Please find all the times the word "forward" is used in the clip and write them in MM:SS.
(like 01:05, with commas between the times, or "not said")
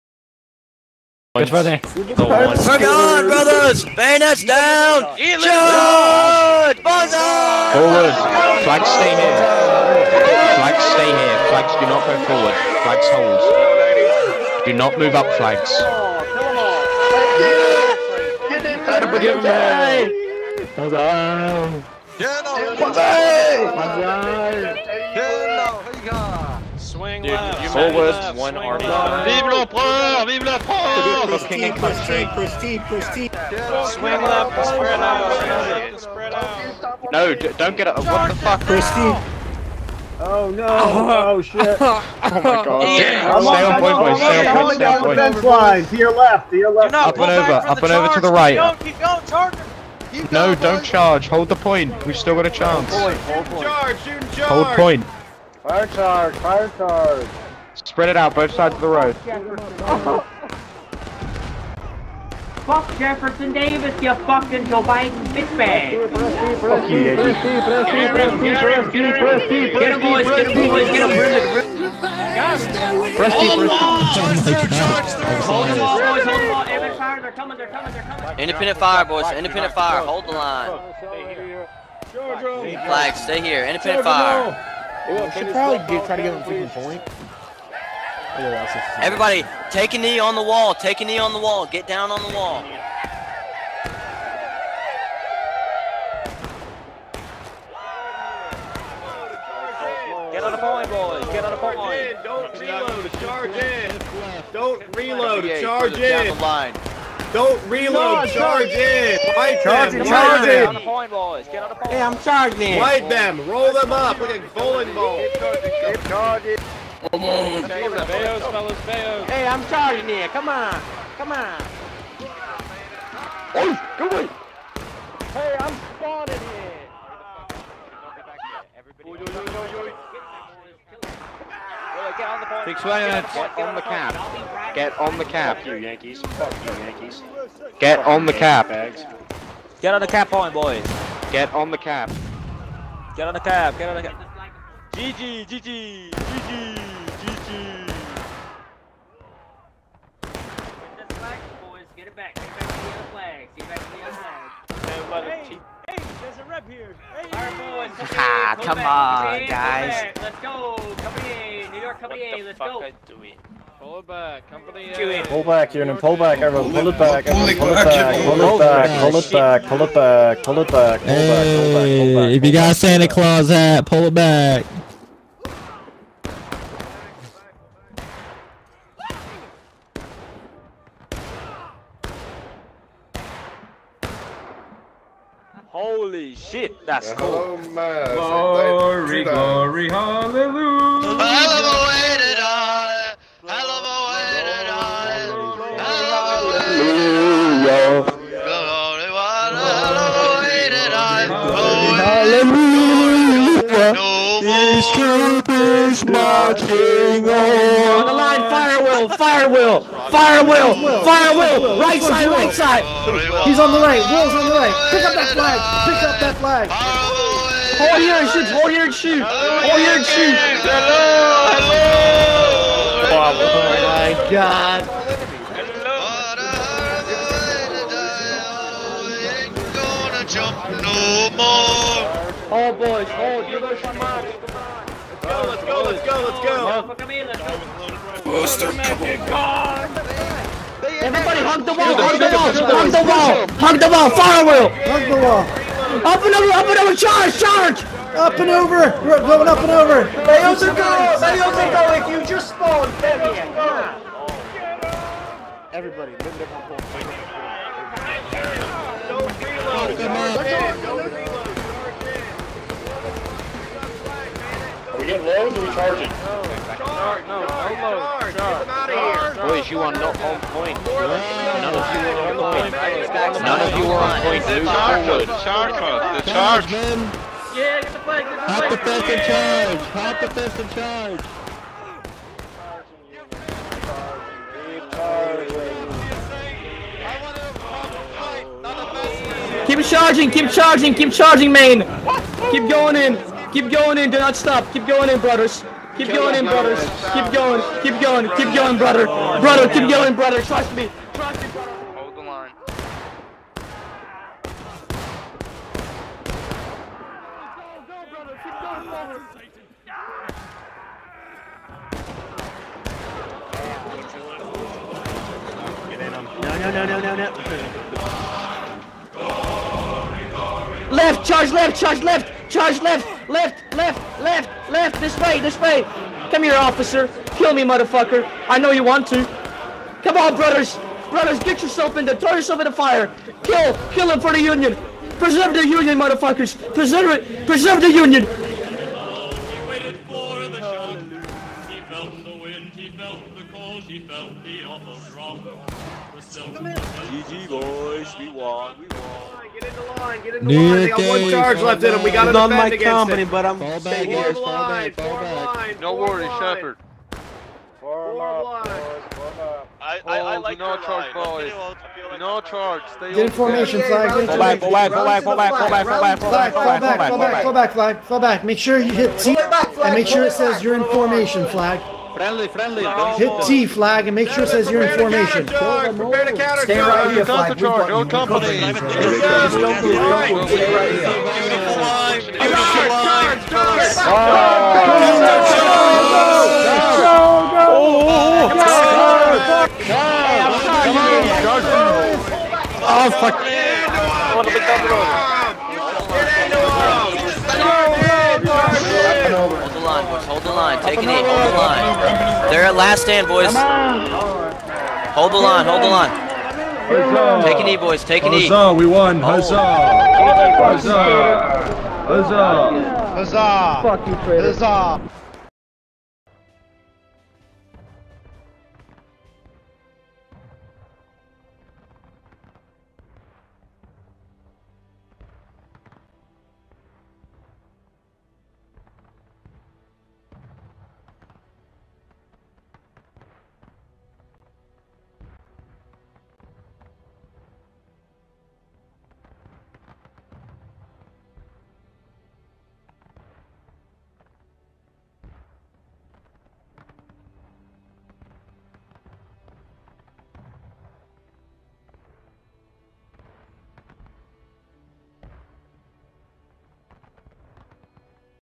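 00:07, 00:12, 00:27, 04:34.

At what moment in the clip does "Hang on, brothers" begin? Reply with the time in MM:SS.
00:01.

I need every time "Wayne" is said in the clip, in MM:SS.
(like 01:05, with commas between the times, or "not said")
not said.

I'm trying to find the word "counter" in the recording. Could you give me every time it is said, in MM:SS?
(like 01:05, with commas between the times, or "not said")
06:16.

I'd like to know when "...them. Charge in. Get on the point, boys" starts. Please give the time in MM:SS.
01:49.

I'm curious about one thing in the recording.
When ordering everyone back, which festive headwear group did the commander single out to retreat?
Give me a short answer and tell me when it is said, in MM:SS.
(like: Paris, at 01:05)
Santa Claus hat, at 02:52.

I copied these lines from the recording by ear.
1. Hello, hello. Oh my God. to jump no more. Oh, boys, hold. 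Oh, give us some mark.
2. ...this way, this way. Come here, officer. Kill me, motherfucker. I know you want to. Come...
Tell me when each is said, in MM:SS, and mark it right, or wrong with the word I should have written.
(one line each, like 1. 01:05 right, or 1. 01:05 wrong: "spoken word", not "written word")
1. 03:40 right
2. 05:24 right.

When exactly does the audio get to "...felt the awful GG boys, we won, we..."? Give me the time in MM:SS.
05:43.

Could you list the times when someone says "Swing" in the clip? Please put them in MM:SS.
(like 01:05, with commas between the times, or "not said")
00:33.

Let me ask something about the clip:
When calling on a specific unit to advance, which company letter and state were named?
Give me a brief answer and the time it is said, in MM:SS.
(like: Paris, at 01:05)
Company A, New York, at 02:40.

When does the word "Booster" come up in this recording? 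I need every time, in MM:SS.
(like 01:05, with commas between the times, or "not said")
03:58.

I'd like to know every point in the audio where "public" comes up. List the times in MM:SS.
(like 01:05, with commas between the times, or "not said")
not said.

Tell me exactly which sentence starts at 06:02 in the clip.
No charge, stay in formation, Flag.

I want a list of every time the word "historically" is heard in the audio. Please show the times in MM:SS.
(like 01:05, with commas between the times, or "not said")
not said.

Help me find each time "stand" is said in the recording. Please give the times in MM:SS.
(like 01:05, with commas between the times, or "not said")
06:43.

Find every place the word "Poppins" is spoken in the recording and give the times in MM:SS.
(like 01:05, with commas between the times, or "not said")
not said.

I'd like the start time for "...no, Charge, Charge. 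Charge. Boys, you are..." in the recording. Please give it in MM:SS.
04:27.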